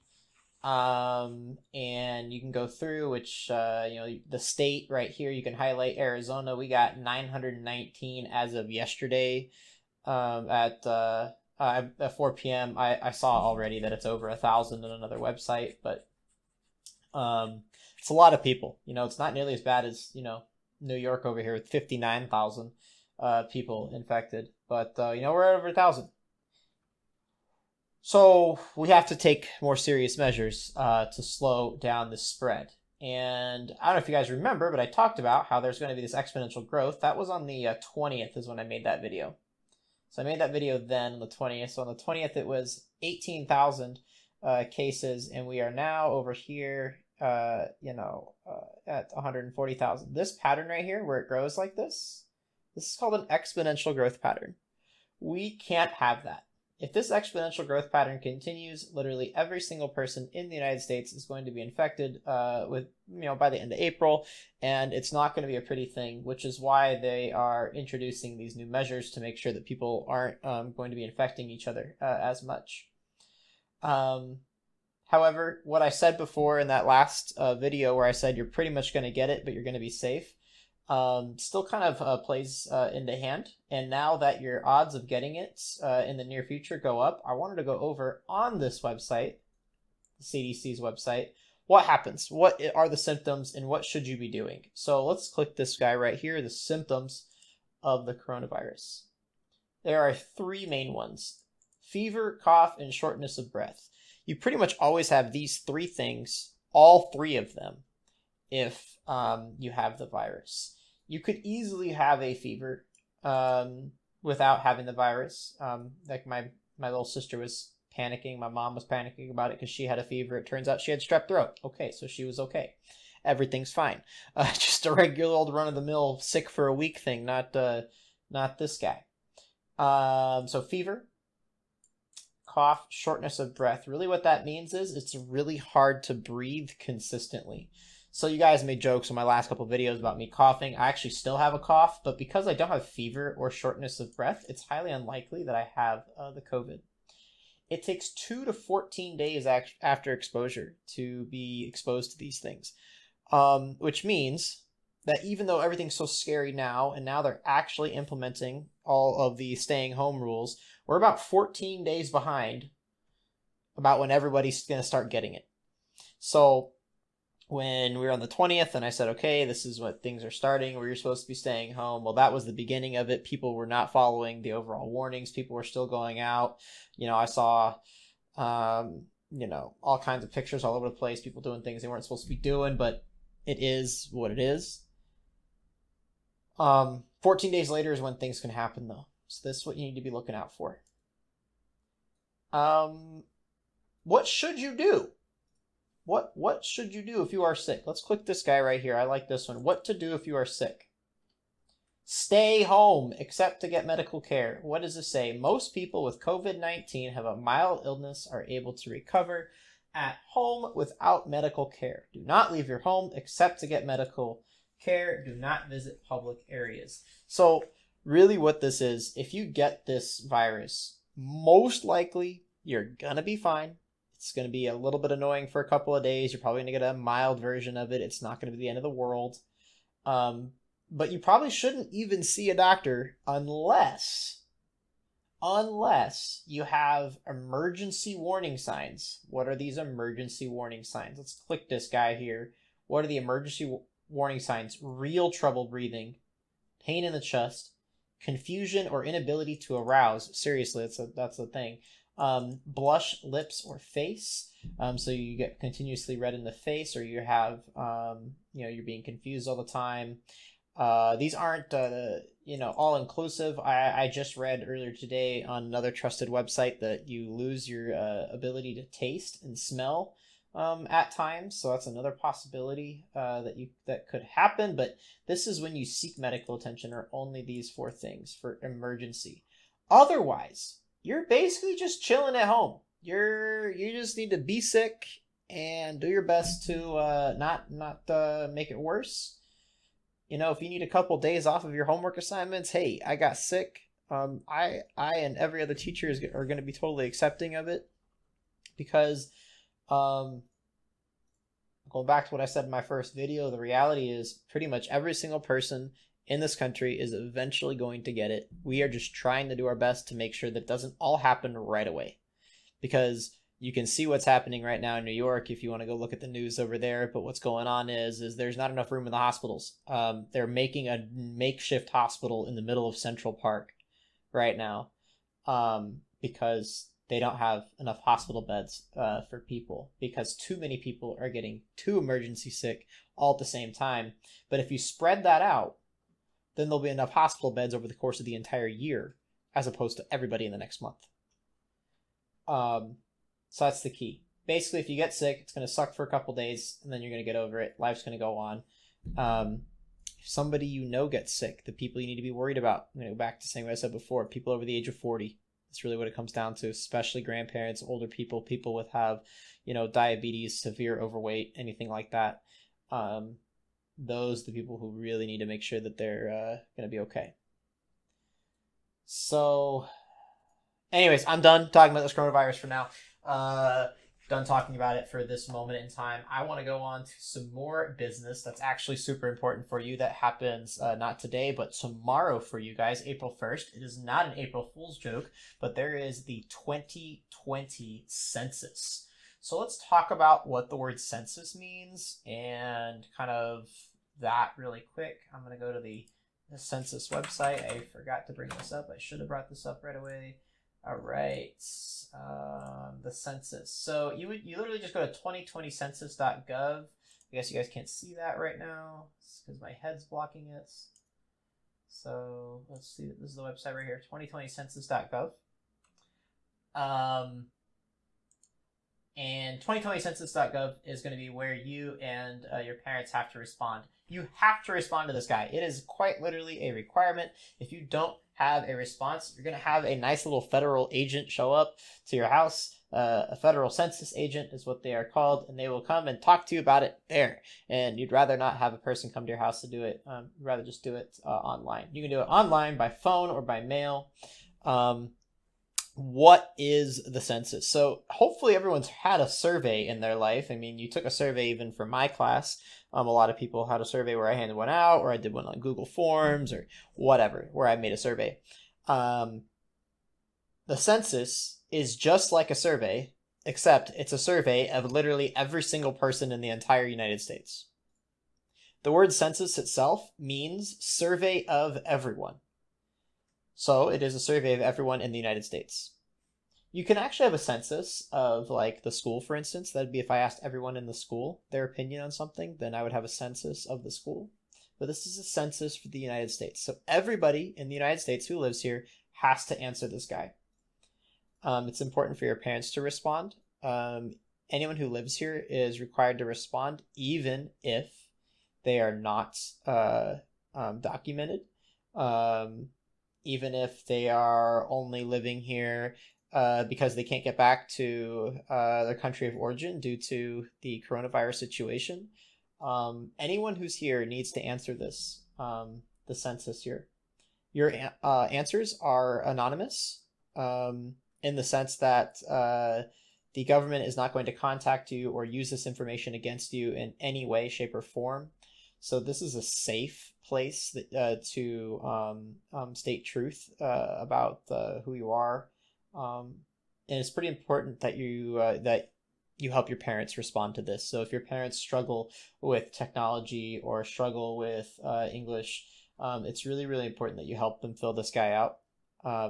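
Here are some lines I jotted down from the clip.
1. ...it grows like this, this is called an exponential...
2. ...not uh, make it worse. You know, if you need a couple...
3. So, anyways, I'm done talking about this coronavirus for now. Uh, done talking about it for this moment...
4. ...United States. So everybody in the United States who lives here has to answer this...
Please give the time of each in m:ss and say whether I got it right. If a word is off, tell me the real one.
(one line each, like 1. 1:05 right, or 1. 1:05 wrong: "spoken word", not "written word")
1. 0:51 right
2. 4:47 right
3. 6:09 right
4. 8:05 right.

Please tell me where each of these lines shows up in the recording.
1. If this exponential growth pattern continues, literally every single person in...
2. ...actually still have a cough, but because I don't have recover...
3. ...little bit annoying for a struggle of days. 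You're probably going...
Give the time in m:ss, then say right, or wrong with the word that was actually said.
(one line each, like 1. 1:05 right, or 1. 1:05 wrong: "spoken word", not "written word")
1. 0:56 right
2. 2:20 wrong: "fever", not "recover"
3. 3:44 wrong: "couple", not "struggle".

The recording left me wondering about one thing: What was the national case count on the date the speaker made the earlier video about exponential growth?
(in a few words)
18,000.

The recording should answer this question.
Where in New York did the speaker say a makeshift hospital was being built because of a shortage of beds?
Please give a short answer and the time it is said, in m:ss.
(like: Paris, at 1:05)
Central Park, at 5:22.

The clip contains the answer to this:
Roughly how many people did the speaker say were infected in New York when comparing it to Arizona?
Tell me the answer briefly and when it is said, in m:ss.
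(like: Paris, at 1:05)
59,000, at 0:21.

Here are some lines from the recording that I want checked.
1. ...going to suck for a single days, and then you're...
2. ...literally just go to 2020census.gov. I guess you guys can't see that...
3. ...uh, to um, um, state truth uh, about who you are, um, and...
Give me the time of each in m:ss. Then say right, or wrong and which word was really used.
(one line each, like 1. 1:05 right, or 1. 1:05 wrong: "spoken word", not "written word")
1. 5:45 wrong: "couple", not "single"
2. 6:44 right
3. 8:50 right.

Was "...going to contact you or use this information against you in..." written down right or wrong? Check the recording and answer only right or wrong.
right.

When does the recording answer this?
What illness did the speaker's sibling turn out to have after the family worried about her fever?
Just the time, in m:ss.
2:00.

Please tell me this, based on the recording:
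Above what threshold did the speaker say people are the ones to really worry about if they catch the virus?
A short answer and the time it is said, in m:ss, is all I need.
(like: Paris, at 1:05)
40, at 5:54.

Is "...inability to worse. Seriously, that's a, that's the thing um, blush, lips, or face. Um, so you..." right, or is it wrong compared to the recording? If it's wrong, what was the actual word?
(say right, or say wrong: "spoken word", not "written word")
wrong: "arouse", not "worse".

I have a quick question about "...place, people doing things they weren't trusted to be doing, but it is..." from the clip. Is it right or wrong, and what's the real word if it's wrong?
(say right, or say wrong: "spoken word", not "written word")
wrong: "supposed", not "trusted".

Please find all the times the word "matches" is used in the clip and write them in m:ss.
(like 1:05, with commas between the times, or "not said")
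not said.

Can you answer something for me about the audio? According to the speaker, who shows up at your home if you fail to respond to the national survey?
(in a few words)
a federal census agent.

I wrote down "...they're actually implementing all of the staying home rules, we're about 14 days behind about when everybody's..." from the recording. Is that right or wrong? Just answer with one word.
right.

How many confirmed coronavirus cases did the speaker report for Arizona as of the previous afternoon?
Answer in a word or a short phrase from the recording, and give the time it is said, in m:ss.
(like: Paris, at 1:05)
919, at 0:06.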